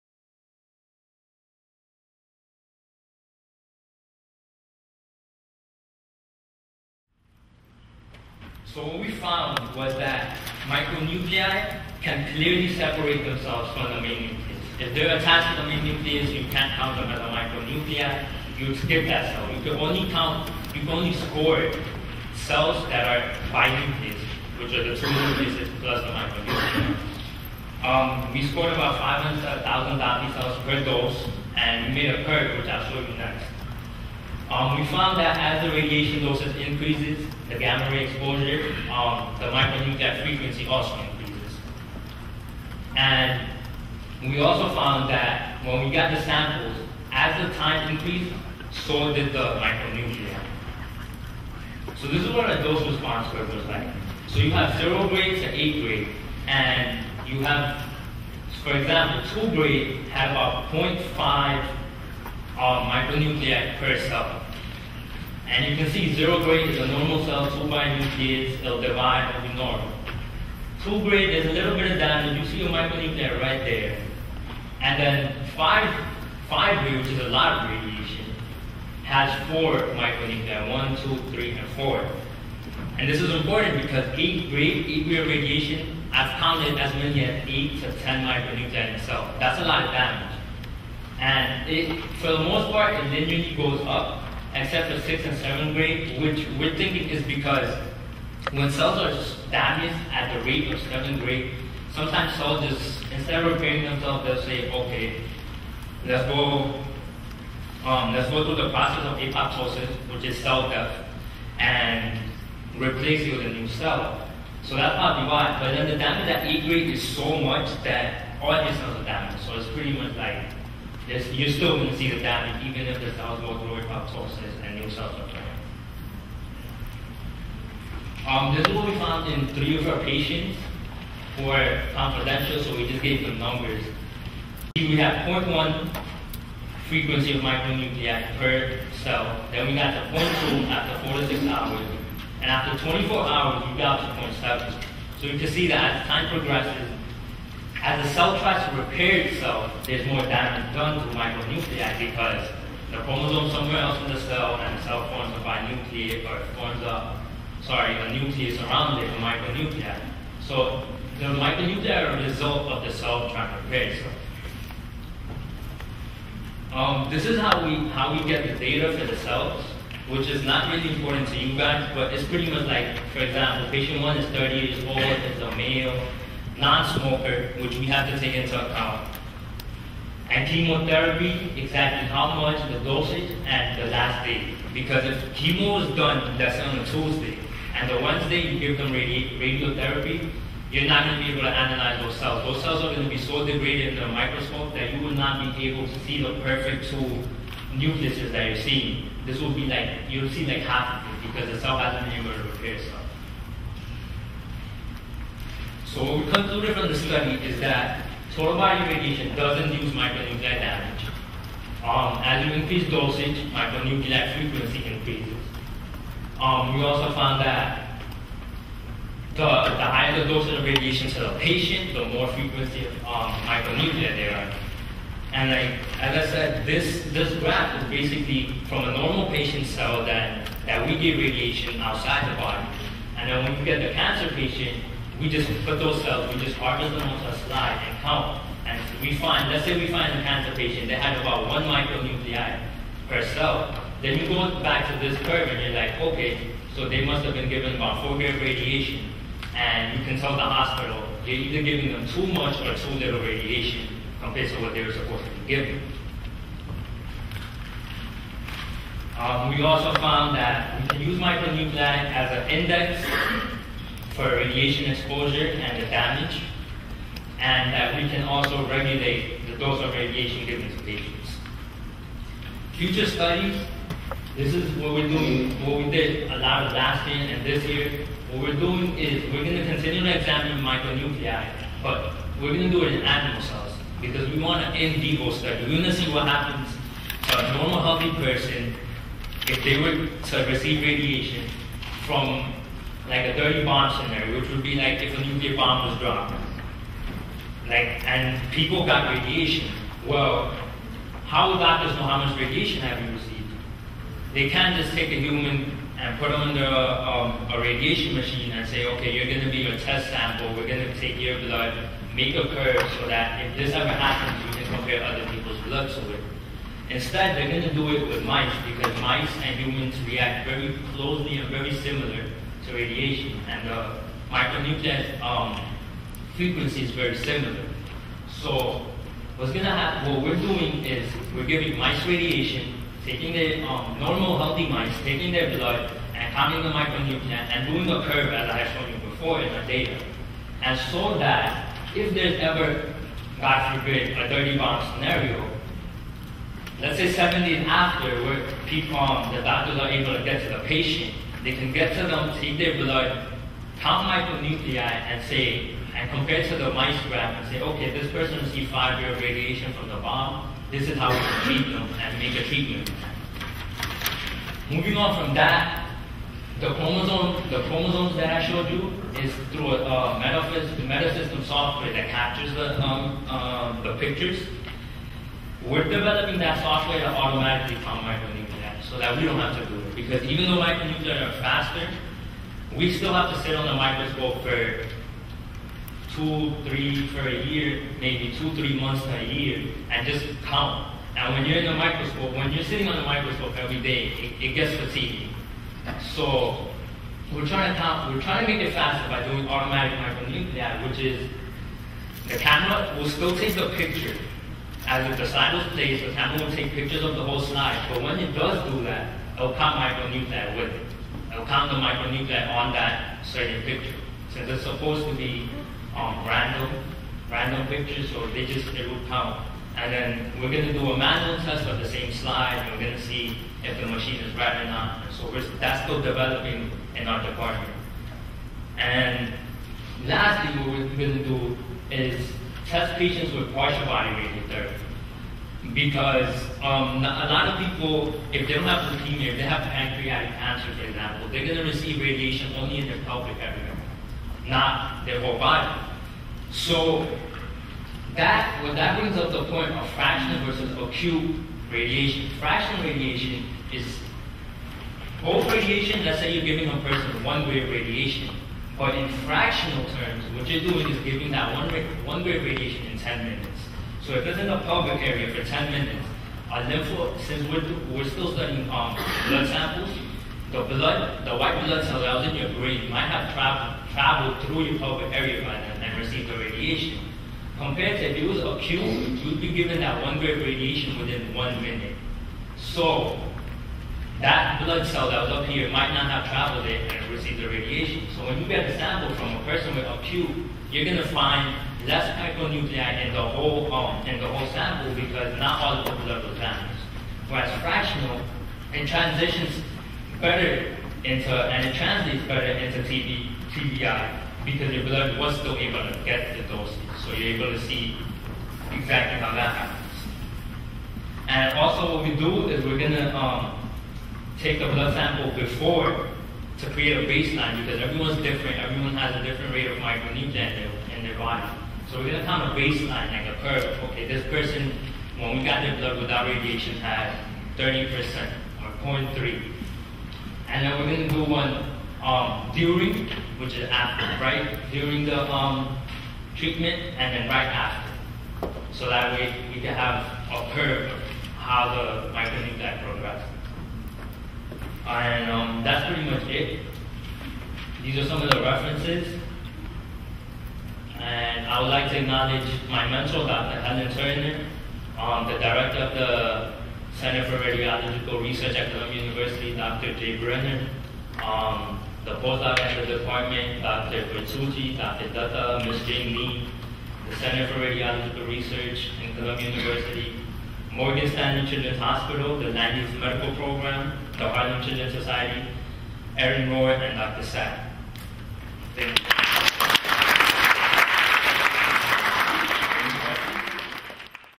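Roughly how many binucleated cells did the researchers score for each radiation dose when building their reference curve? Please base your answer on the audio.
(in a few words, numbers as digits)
500,000.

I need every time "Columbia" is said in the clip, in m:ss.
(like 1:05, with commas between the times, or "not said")
9:18, 9:29.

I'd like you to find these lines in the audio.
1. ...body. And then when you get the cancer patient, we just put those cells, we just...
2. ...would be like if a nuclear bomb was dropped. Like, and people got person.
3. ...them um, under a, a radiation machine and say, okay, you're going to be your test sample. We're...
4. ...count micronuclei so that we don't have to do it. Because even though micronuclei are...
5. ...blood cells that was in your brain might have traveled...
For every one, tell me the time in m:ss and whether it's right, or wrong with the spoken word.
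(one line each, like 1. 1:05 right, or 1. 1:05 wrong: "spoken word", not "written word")
1. 3:52 right
2. 4:54 wrong: "radiation", not "person"
3. 5:06 right
4. 6:17 right
5. 7:51 right.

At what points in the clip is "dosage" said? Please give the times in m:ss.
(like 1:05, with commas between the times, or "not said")
0:36, 3:02, 3:32, 3:40, 8:26.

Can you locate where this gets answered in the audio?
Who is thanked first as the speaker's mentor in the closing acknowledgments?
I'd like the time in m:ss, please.
9:13.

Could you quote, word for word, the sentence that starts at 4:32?
Future studies, this is what we're doing, what we did a lot of last year and this year.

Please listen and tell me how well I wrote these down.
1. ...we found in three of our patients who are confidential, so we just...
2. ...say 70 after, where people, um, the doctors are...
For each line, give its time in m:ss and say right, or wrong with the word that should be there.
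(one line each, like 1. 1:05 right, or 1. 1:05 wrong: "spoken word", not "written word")
1. 2:08 right
2. 5:46 right.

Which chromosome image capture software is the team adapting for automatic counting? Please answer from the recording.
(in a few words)
metasystem.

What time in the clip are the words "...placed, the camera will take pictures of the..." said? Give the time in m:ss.
6:45.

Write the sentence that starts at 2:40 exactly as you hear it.
So the micronuclei are a result of the cell trying to repair itself.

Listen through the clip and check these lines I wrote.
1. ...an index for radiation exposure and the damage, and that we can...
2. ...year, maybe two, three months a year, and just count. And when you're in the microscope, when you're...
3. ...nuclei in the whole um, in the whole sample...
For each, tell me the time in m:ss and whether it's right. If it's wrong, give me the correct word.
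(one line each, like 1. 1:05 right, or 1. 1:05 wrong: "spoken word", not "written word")
1. 4:22 right
2. 6:27 right
3. 8:12 right.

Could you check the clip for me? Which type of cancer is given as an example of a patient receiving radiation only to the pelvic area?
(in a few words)
pancreatic cancer.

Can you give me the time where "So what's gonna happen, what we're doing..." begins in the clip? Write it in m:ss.
5:28.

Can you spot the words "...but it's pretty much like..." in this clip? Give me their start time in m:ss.
2:51.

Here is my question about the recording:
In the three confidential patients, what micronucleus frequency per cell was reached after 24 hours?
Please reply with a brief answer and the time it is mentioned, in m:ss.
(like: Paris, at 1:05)
0.7, at 2:24.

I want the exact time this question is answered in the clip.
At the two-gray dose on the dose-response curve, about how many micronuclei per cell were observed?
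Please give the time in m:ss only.
1:00.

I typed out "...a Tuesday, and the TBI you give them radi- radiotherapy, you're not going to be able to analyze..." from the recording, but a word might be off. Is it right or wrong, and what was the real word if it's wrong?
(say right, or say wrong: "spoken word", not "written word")
wrong: "Wednesday", not "TBI".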